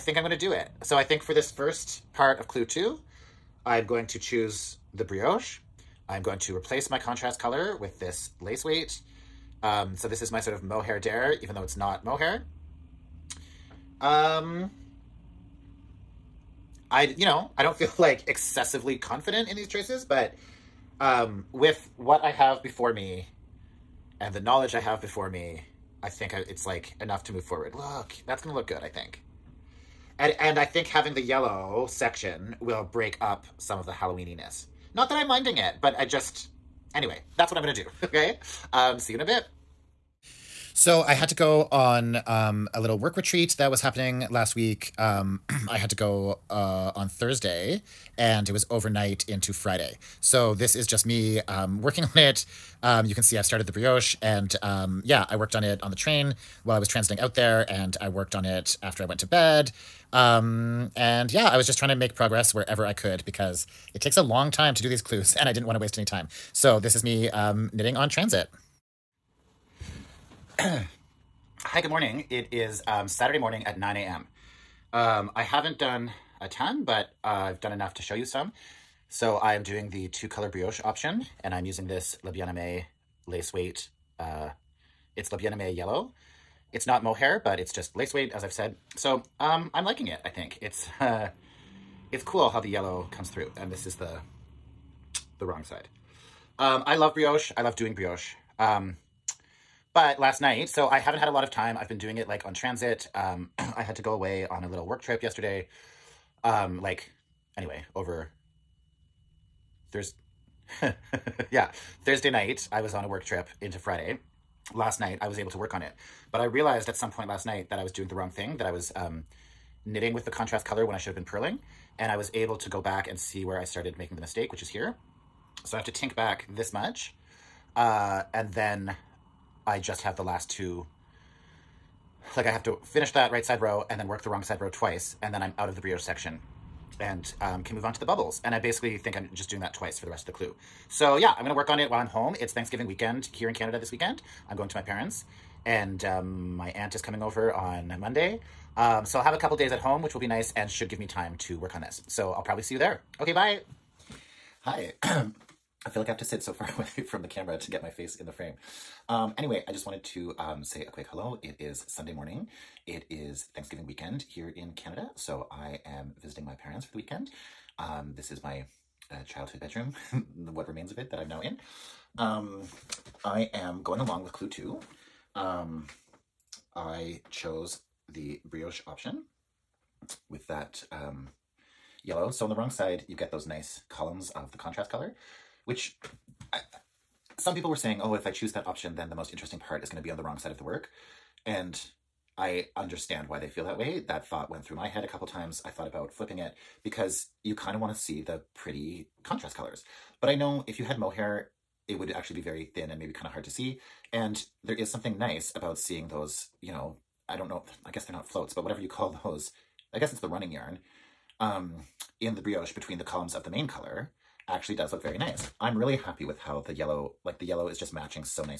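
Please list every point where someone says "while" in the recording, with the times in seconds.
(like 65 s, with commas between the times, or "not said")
56 s, 141 s.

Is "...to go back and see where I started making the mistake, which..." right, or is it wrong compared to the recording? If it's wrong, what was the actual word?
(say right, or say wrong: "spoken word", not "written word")
right.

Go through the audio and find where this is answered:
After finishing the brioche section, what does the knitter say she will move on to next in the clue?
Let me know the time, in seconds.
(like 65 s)
138 s.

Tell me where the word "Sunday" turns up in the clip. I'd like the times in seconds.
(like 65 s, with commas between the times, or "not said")
161 s.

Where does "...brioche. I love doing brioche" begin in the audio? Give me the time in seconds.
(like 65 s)
97 s.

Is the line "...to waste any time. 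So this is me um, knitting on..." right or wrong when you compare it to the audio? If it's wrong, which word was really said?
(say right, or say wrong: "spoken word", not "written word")
right.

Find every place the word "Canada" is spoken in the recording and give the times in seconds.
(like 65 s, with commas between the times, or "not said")
143 s, 164 s.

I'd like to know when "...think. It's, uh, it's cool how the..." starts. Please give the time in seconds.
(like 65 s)
90 s.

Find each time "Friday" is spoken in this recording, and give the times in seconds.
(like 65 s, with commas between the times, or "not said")
49 s, 113 s.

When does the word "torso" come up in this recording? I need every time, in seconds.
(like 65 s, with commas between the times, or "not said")
not said.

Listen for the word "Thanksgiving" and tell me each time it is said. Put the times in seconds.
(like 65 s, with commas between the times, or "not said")
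142 s, 163 s.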